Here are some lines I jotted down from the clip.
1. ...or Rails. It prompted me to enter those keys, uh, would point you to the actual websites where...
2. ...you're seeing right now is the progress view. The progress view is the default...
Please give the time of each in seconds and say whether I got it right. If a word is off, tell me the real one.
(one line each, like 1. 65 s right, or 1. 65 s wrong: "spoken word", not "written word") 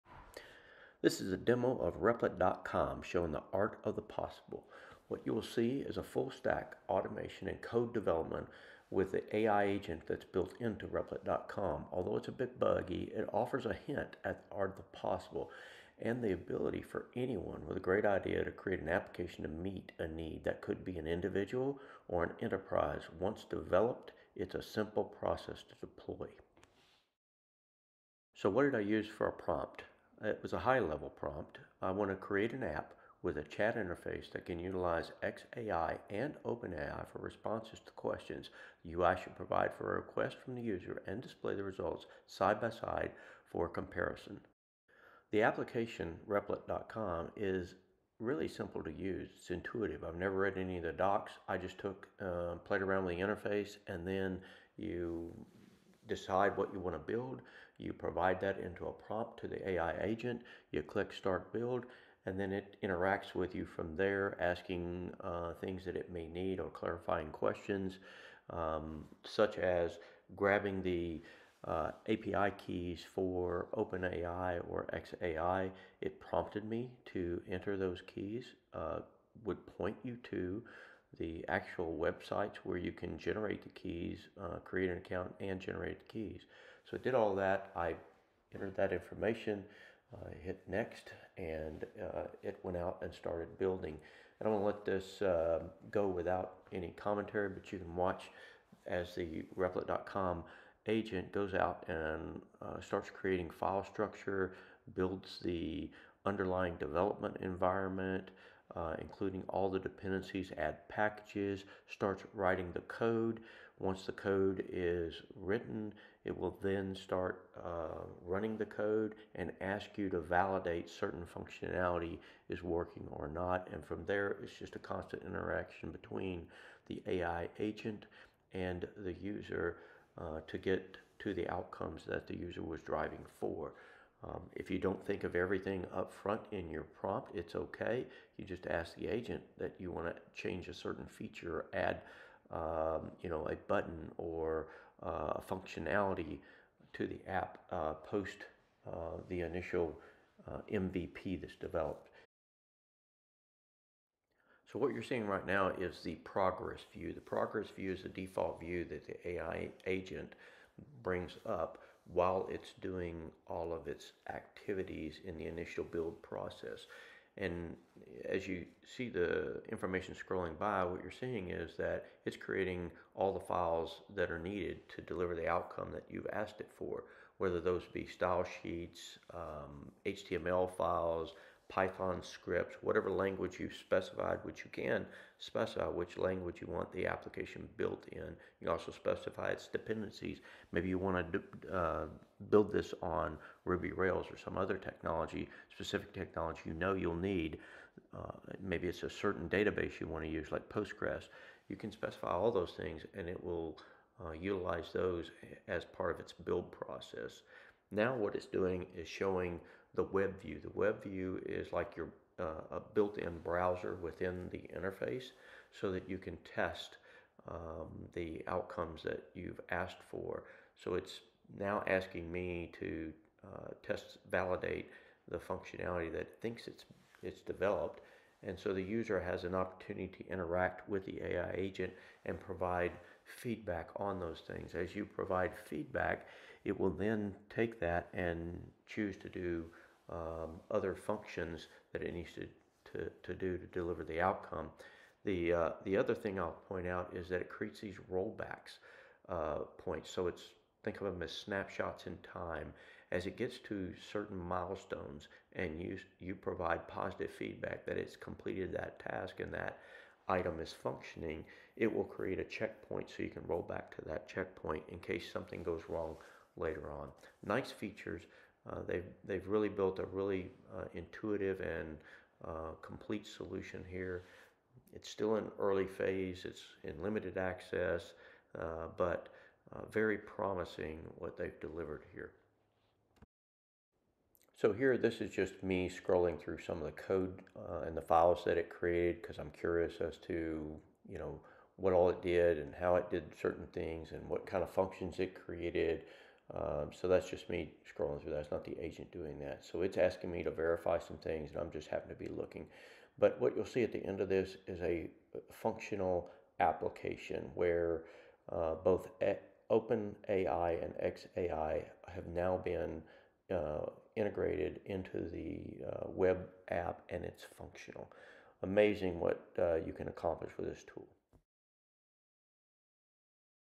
1. 74 s wrong: "XAI", not "Rails"
2. 154 s right.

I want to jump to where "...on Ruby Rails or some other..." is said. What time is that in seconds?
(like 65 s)
193 s.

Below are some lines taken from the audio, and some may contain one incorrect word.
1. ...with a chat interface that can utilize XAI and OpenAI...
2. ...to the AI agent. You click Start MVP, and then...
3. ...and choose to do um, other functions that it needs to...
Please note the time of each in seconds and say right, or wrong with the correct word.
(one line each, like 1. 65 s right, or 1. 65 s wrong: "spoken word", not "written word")
1. 33 s right
2. 59 s wrong: "Build", not "MVP"
3. 238 s right.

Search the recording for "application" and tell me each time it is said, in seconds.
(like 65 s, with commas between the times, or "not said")
18 s, 45 s, 187 s, 306 s.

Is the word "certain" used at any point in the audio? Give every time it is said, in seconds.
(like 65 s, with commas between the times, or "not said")
120 s, 140 s, 199 s, 254 s, 293 s.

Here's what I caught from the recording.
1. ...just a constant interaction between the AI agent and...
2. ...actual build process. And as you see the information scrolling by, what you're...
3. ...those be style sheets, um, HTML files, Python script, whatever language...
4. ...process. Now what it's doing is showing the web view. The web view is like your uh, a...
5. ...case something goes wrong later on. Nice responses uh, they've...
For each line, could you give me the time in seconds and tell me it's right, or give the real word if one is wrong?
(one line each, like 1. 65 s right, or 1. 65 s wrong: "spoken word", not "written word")
1. 124 s right
2. 165 s wrong: "initial", not "actual"
3. 177 s right
4. 206 s right
5. 264 s wrong: "features", not "responses".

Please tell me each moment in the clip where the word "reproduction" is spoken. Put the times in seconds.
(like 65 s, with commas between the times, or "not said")
not said.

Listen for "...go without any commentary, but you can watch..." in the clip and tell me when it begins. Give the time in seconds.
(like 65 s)
95 s.